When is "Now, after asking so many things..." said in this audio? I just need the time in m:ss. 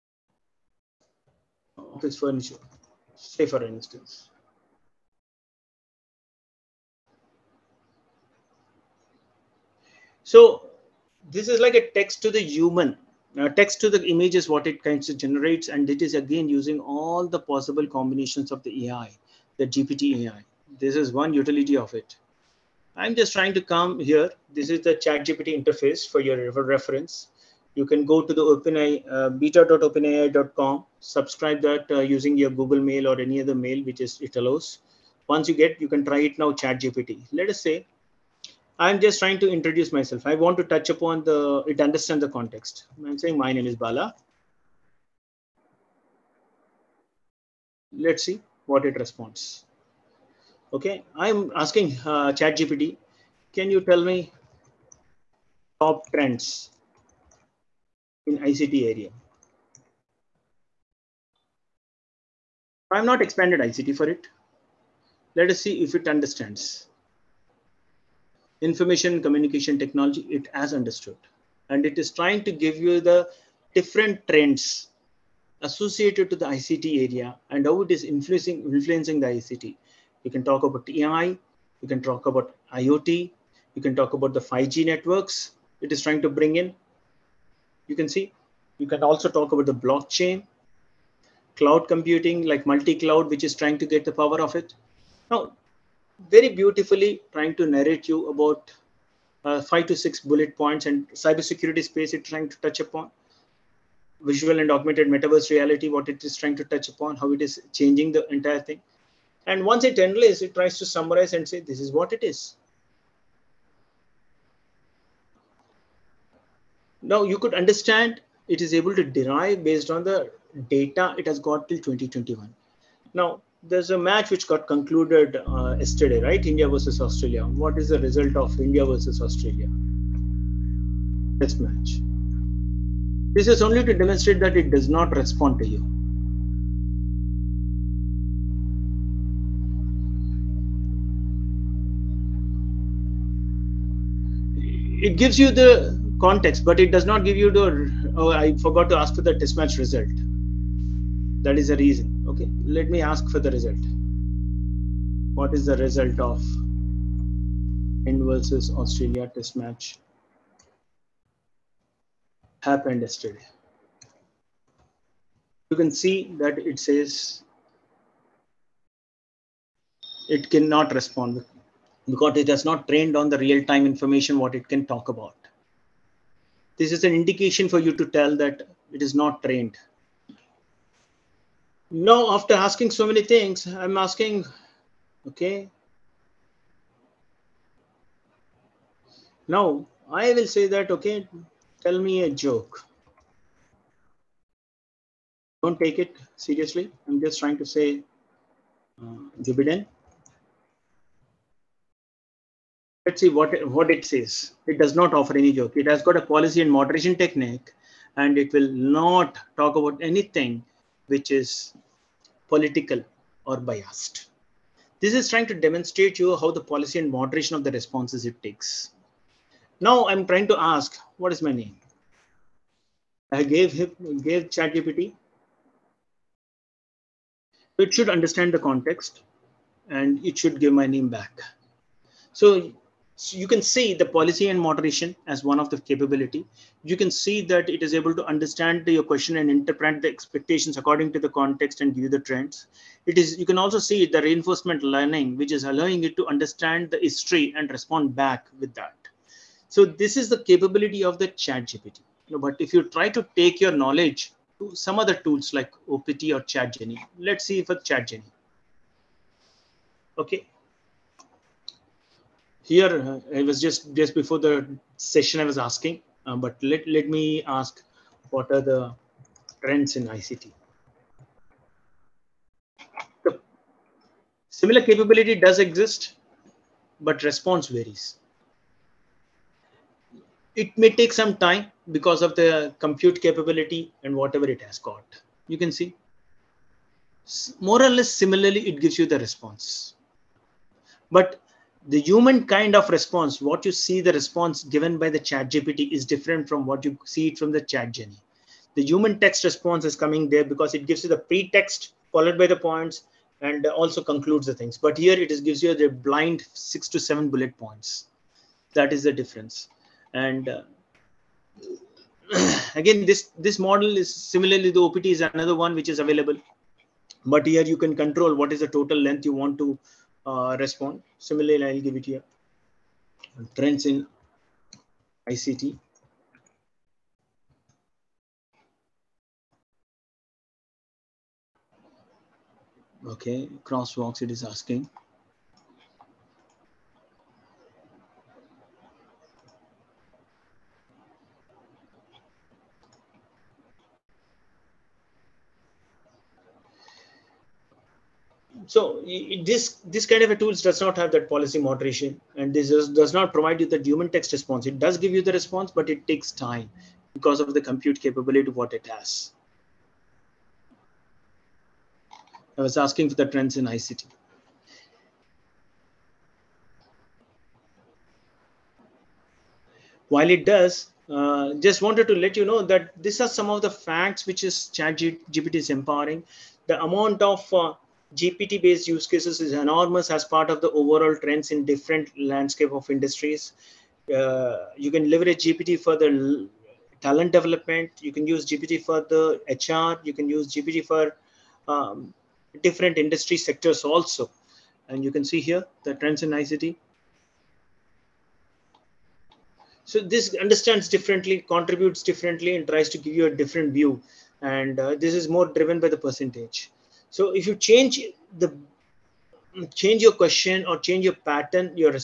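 3:01.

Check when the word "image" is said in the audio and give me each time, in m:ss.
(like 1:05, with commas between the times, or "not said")
0:14.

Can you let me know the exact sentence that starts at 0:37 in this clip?
Let us say, I'm just trying to introduce myself.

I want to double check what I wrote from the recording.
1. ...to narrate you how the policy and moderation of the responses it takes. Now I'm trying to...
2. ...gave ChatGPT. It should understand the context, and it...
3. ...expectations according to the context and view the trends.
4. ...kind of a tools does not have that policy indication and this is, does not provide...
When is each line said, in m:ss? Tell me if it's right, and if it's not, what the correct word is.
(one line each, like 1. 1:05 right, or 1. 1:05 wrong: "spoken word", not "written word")
1. 3:35 wrong: "demonstrate", not "narrate"
2. 3:44 right
3. 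4:00 right
4. 5:50 wrong: "moderation", not "indication".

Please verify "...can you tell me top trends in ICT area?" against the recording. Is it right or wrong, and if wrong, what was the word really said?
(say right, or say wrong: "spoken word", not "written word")
right.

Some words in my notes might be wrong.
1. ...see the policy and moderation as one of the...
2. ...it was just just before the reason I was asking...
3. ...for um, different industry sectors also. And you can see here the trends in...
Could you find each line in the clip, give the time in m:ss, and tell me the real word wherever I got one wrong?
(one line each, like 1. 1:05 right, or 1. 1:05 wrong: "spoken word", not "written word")
1. 3:53 right
2. 4:23 wrong: "session", not "reason"
3. 6:30 right.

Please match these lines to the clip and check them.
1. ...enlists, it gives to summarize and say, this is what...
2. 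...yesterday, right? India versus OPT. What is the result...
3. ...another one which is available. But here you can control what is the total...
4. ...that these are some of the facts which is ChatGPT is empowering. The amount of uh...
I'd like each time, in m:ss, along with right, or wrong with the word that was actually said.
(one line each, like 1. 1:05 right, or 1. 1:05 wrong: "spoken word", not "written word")
1. 1:49 wrong: "tries", not "gives"
2. 2:05 wrong: "Australia", not "OPT"
3. 5:15 right
4. 6:12 right.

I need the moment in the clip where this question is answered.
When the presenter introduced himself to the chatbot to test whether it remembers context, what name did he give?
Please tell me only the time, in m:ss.
0:43.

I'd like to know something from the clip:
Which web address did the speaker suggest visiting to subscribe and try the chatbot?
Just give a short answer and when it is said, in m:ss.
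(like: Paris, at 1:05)
beta.openai.com, at 0:29.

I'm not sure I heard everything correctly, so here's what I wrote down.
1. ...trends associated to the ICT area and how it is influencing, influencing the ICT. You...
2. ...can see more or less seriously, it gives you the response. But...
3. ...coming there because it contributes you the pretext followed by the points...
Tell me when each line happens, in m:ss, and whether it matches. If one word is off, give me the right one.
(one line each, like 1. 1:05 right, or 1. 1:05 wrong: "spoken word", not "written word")
1. 1:14 right
2. 4:45 wrong: "similarly", not "seriously"
3. 4:59 wrong: "gives", not "contributes".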